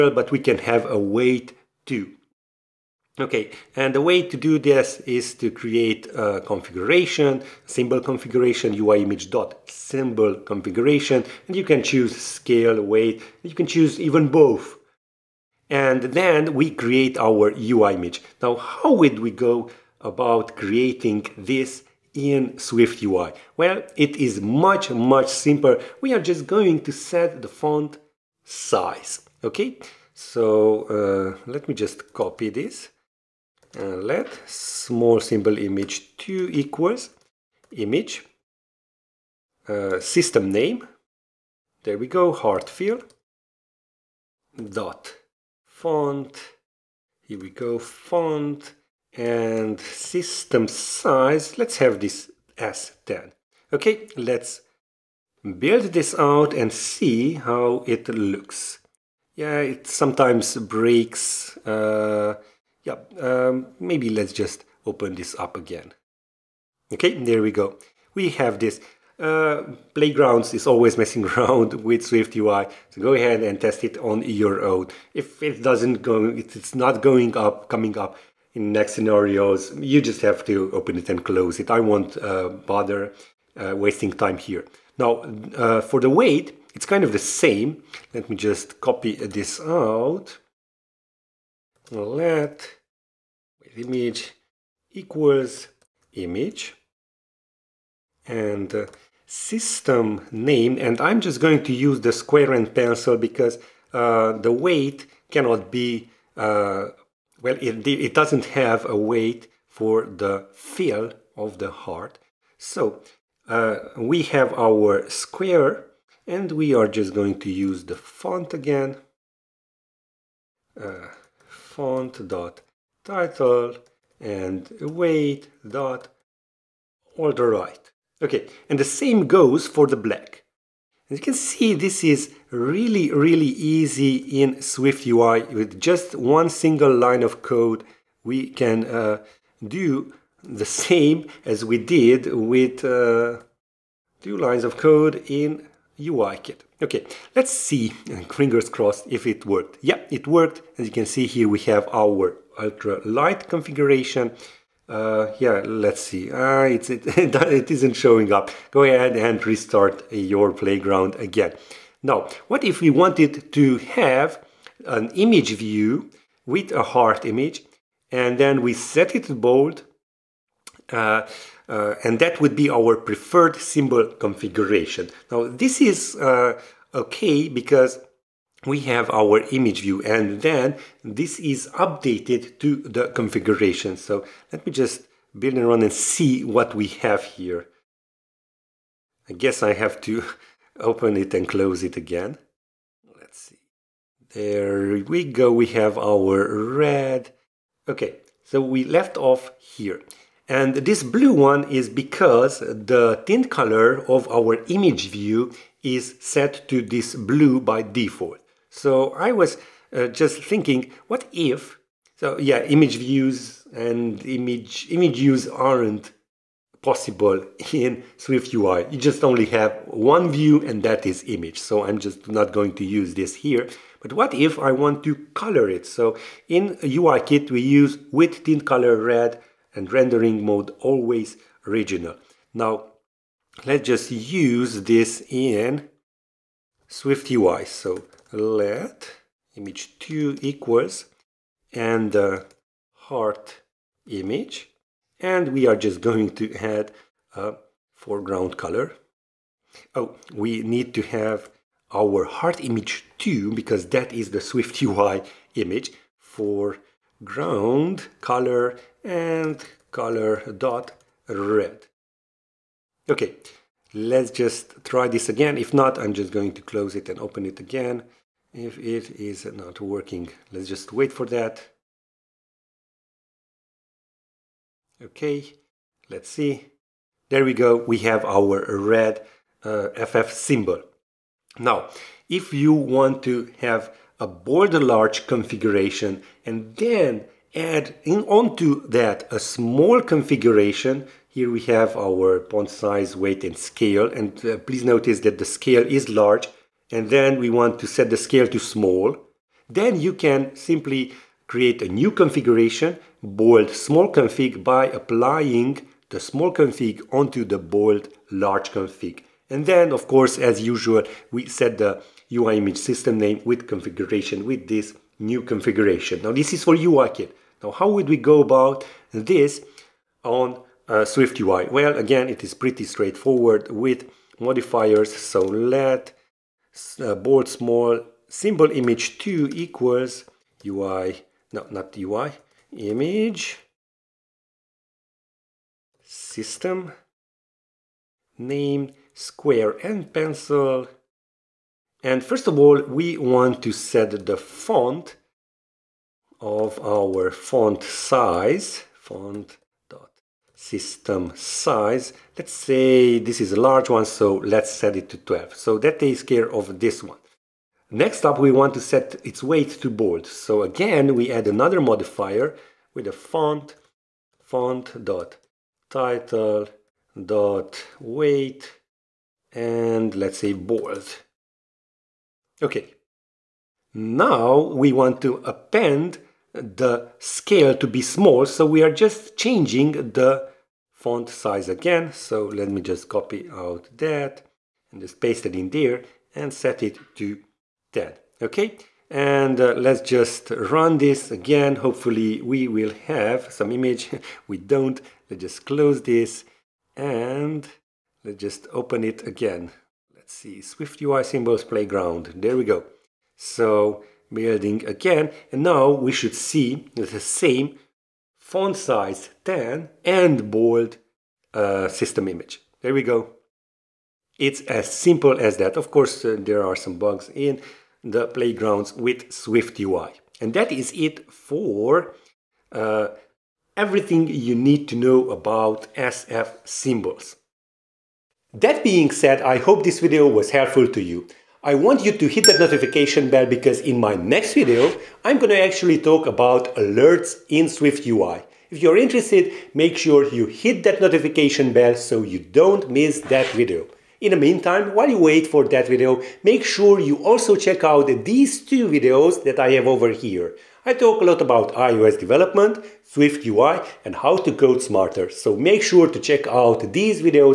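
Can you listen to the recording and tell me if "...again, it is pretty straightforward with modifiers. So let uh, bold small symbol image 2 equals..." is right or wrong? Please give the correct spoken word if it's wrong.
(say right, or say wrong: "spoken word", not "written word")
right.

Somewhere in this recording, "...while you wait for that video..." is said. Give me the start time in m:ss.
7:24.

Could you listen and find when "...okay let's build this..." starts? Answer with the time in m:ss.
0:53.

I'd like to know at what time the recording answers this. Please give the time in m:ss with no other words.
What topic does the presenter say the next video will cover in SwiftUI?
7:16.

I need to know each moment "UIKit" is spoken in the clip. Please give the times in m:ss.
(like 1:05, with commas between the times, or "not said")
2:25, 3:46.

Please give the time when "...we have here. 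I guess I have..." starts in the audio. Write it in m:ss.
3:06.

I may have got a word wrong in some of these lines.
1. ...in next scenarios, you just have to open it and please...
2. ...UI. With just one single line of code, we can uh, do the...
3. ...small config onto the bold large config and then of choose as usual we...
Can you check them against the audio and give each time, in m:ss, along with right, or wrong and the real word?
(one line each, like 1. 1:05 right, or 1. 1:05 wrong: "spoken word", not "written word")
1. 1:18 wrong: "close", not "please"
2. 2:15 right
3. 5:06 wrong: "course", not "choose".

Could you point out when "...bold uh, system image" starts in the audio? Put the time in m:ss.
6:50.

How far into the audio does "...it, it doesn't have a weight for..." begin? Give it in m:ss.
1:47.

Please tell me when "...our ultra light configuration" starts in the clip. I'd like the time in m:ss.
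2:31.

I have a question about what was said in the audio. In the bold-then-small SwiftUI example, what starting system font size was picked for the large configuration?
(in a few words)
12.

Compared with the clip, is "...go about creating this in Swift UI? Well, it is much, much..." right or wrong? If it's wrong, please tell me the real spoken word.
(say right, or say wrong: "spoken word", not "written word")
right.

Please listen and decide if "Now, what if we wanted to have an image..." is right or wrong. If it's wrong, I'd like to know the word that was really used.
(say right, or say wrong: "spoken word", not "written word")
right.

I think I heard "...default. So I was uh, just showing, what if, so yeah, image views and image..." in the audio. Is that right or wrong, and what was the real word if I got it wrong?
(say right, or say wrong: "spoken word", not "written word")
wrong: "thinking", not "showing".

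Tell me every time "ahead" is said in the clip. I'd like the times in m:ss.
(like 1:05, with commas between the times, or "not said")
1:13, 2:38.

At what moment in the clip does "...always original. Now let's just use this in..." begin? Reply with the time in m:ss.
3:50.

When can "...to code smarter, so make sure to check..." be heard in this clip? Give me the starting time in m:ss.
7:34.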